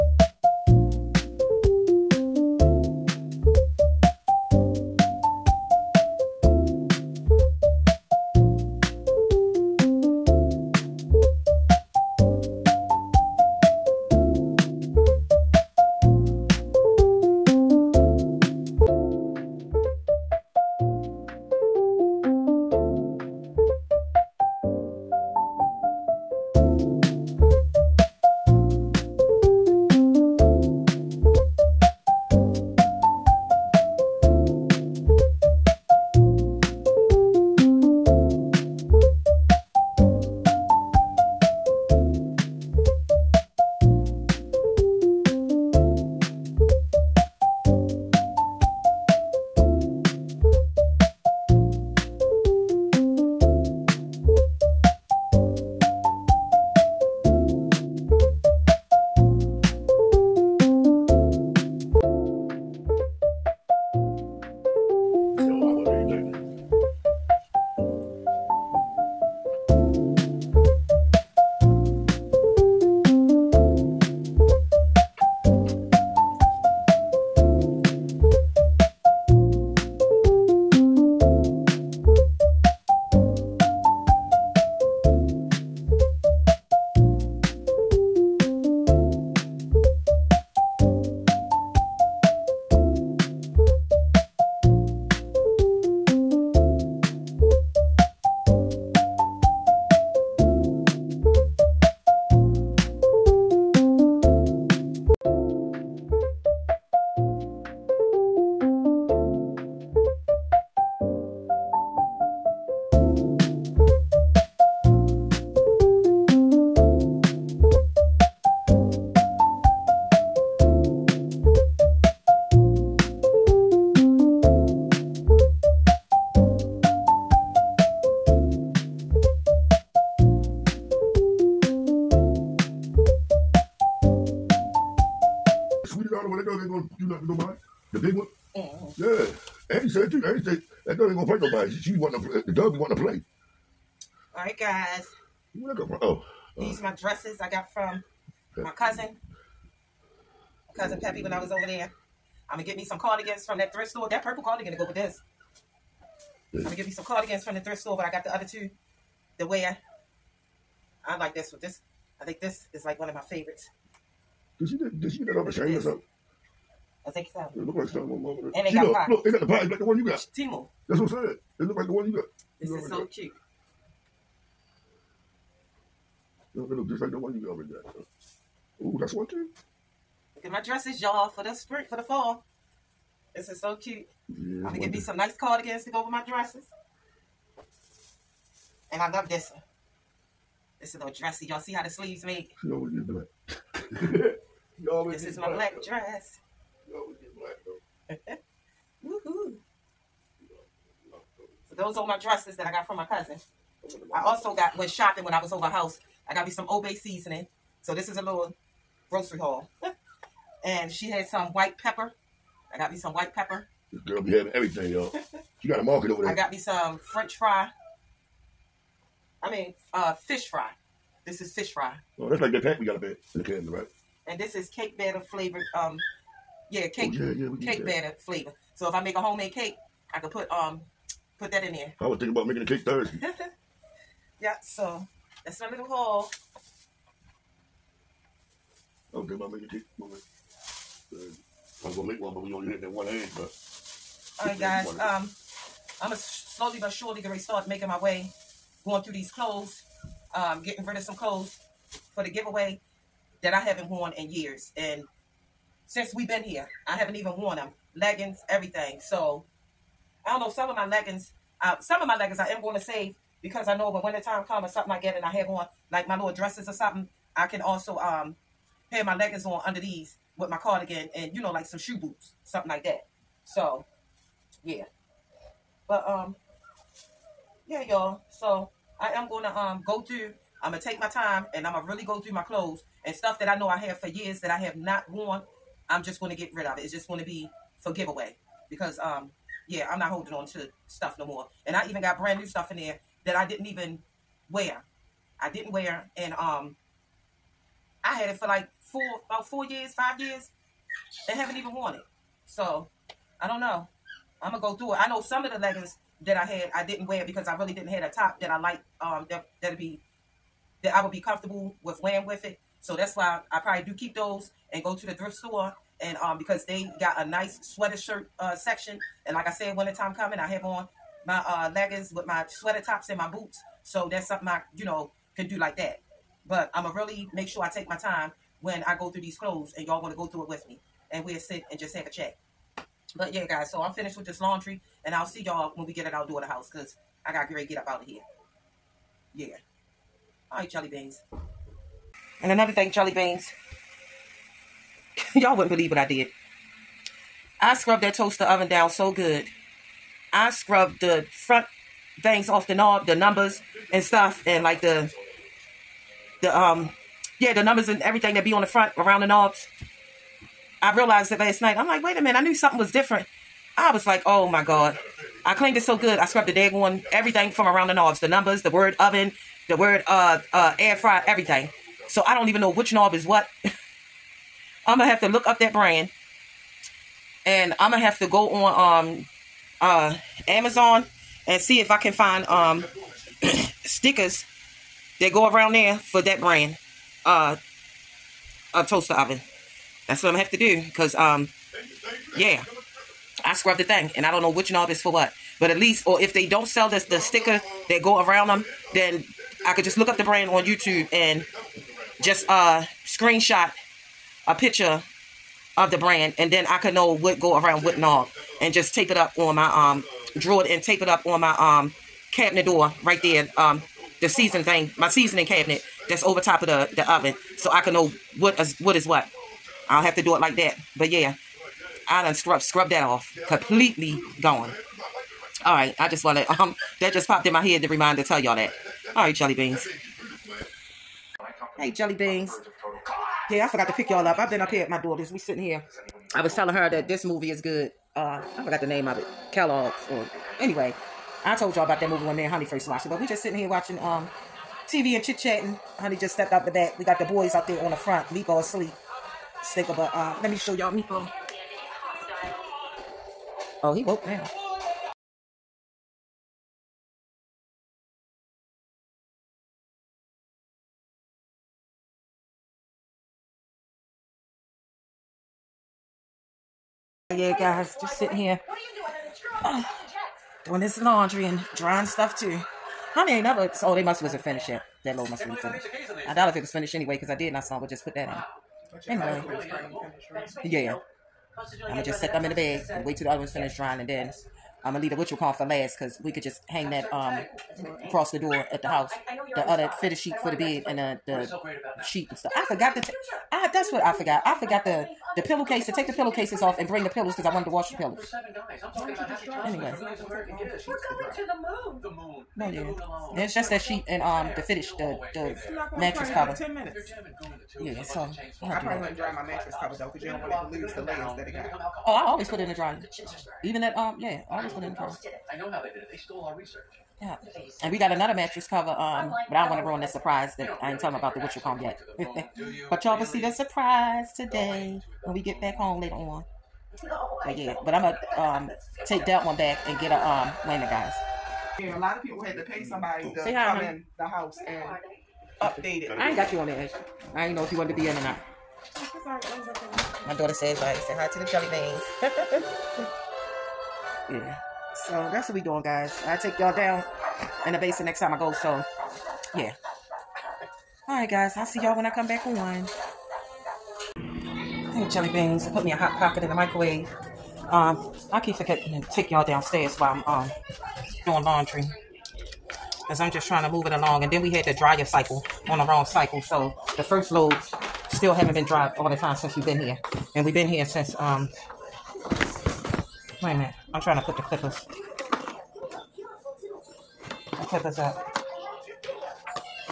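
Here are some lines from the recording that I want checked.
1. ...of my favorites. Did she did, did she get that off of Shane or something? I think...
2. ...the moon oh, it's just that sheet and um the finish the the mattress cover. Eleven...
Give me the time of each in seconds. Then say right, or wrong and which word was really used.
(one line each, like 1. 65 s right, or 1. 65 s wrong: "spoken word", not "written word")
1. 163 s right
2. 502 s wrong: "Ten", not "Eleven".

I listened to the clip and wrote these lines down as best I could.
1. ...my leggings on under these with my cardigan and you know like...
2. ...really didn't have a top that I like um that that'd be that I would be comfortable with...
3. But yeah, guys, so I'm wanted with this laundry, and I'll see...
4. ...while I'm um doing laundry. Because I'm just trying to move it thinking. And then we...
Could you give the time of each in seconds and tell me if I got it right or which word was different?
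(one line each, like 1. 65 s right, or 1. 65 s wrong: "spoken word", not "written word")
1. 269 s right
2. 307 s right
3. 333 s wrong: "finished", not "wanted"
4. 559 s wrong: "along", not "thinking".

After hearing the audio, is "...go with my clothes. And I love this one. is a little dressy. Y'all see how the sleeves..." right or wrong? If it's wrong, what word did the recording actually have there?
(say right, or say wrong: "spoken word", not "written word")
wrong: "dresses", not "clothes".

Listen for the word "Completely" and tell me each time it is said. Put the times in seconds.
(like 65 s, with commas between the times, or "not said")
423 s.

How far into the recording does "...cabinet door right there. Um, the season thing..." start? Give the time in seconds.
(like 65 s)
412 s.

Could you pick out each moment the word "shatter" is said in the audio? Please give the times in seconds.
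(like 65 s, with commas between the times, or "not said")
not said.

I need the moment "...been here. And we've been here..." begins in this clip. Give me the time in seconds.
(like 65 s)
569 s.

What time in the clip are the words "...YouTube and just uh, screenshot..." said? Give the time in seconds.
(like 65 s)
400 s.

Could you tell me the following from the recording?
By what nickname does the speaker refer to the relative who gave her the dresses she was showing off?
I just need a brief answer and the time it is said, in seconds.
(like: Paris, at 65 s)
Peppy, at 150 s.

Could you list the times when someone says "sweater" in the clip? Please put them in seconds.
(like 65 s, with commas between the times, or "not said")
317 s, 322 s.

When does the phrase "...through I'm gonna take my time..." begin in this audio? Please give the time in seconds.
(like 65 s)
280 s.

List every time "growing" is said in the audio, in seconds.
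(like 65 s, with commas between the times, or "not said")
not said.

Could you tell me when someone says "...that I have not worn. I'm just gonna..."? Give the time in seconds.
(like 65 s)
284 s.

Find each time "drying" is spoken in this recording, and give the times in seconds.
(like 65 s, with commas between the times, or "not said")
471 s, 483 s.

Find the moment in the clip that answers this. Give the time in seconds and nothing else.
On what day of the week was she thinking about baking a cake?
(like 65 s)
232 s.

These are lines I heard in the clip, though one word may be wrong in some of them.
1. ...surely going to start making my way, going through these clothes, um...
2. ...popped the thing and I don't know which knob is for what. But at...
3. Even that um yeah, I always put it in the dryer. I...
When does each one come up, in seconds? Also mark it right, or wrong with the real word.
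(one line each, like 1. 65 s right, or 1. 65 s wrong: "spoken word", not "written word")
1. 246 s right
2. 393 s wrong: "scrubbed", not "popped"
3. 513 s right.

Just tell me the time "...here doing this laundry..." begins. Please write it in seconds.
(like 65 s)
468 s.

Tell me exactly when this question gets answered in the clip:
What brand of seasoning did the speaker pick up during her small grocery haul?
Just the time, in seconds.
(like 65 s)
206 s.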